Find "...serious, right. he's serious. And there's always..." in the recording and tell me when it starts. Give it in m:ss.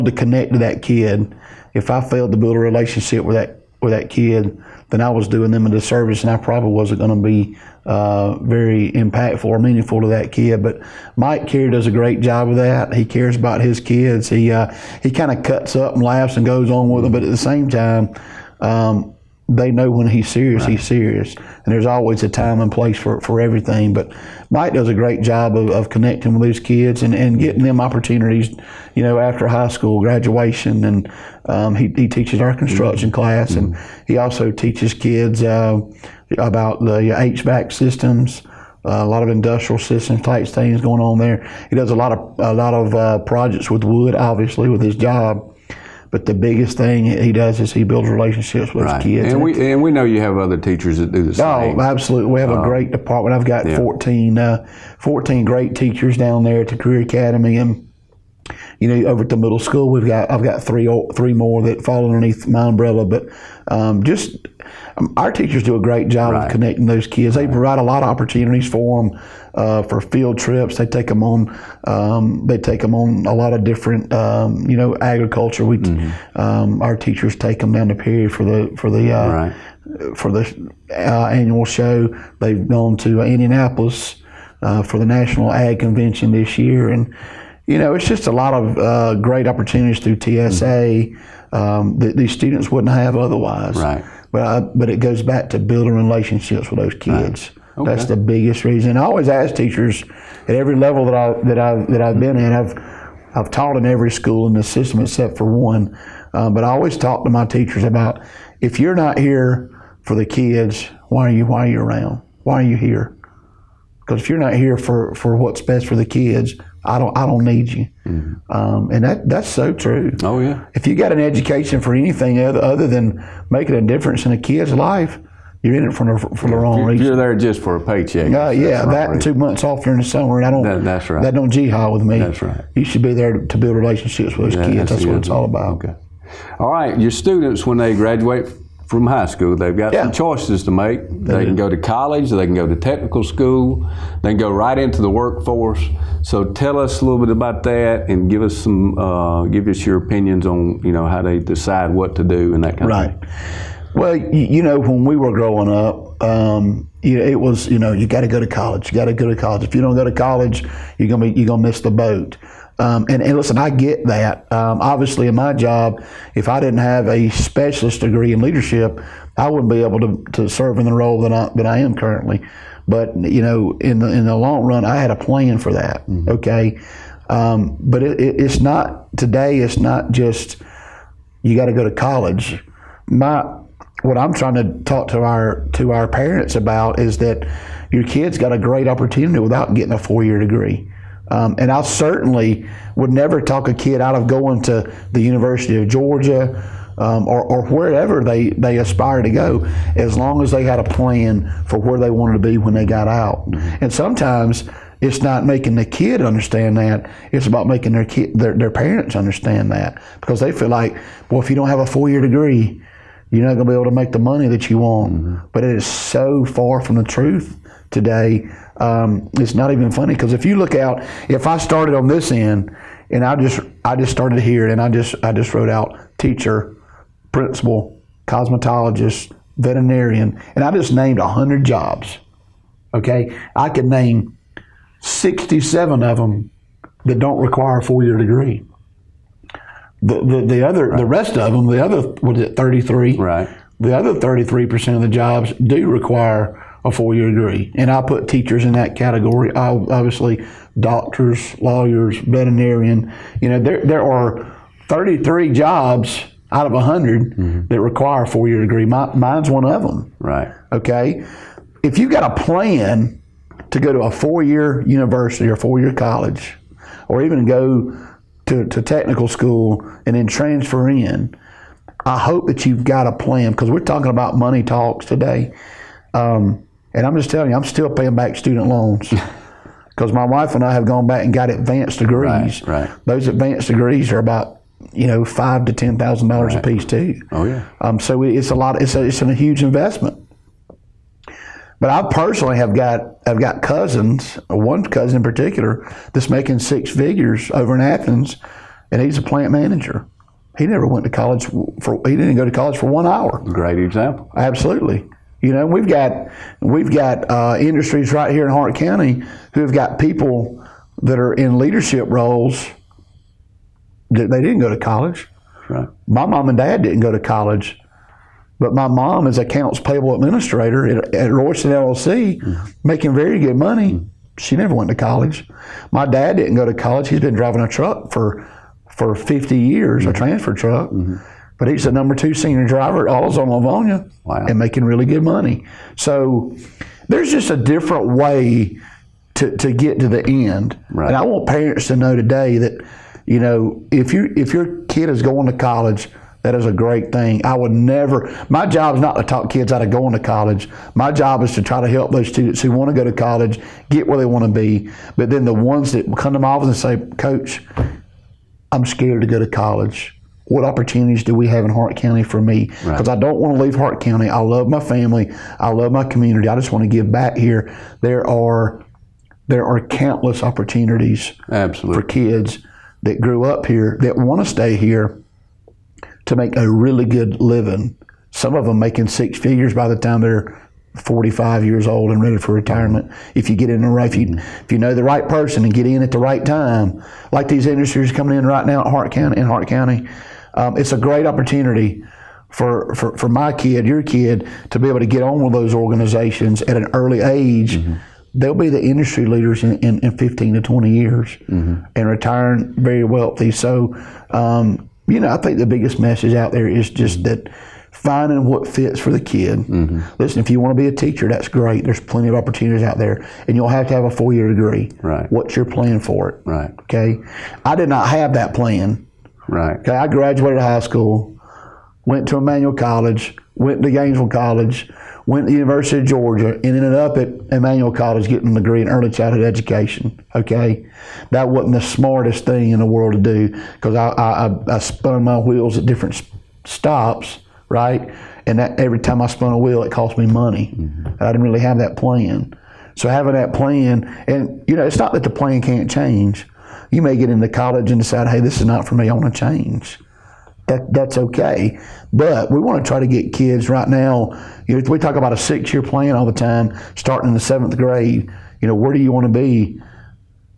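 0:20.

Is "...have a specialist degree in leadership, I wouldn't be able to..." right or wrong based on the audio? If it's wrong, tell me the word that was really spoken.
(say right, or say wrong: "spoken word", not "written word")
right.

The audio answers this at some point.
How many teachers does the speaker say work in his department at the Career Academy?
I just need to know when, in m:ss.
0:54.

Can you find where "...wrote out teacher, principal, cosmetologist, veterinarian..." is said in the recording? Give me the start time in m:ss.
3:45.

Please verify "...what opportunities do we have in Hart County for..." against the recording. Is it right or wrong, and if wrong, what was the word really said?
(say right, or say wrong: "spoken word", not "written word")
right.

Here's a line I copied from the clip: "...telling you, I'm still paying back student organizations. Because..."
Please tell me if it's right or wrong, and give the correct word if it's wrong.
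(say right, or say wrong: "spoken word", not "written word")
wrong: "loans", not "organizations".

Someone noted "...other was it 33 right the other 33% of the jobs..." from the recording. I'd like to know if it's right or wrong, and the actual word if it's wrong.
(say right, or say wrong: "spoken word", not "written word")
right.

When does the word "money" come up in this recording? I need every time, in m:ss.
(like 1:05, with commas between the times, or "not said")
3:34, 4:34, 5:23, 5:35, 7:20.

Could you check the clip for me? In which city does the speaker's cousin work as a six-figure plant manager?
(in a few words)
Athens.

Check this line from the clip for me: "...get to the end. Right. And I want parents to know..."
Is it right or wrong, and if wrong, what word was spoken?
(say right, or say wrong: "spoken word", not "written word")
right.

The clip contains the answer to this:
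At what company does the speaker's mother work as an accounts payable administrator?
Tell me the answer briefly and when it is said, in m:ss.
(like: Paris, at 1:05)
Royston LLC, at 5:21.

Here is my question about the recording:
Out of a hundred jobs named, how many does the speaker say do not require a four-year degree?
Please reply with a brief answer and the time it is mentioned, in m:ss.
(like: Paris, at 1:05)
67, at 3:55.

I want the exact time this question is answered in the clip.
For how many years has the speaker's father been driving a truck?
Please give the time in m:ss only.
5:29.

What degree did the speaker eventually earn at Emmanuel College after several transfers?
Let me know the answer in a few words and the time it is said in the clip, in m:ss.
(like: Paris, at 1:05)
Early childhood education, at 7:08.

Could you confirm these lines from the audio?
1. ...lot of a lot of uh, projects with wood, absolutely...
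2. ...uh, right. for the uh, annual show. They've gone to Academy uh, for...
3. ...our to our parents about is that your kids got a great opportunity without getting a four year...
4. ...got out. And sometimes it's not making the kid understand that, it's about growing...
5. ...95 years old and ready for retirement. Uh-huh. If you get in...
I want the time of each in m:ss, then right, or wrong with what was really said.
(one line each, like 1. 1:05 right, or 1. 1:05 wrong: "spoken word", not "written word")
1. 0:41 wrong: "obviously", not "absolutely"
2. 1:19 wrong: "Indianapolis", not "Academy"
3. 3:05 right
4. 3:22 wrong: "making", not "growing"
5. 6:21 wrong: "45", not "95".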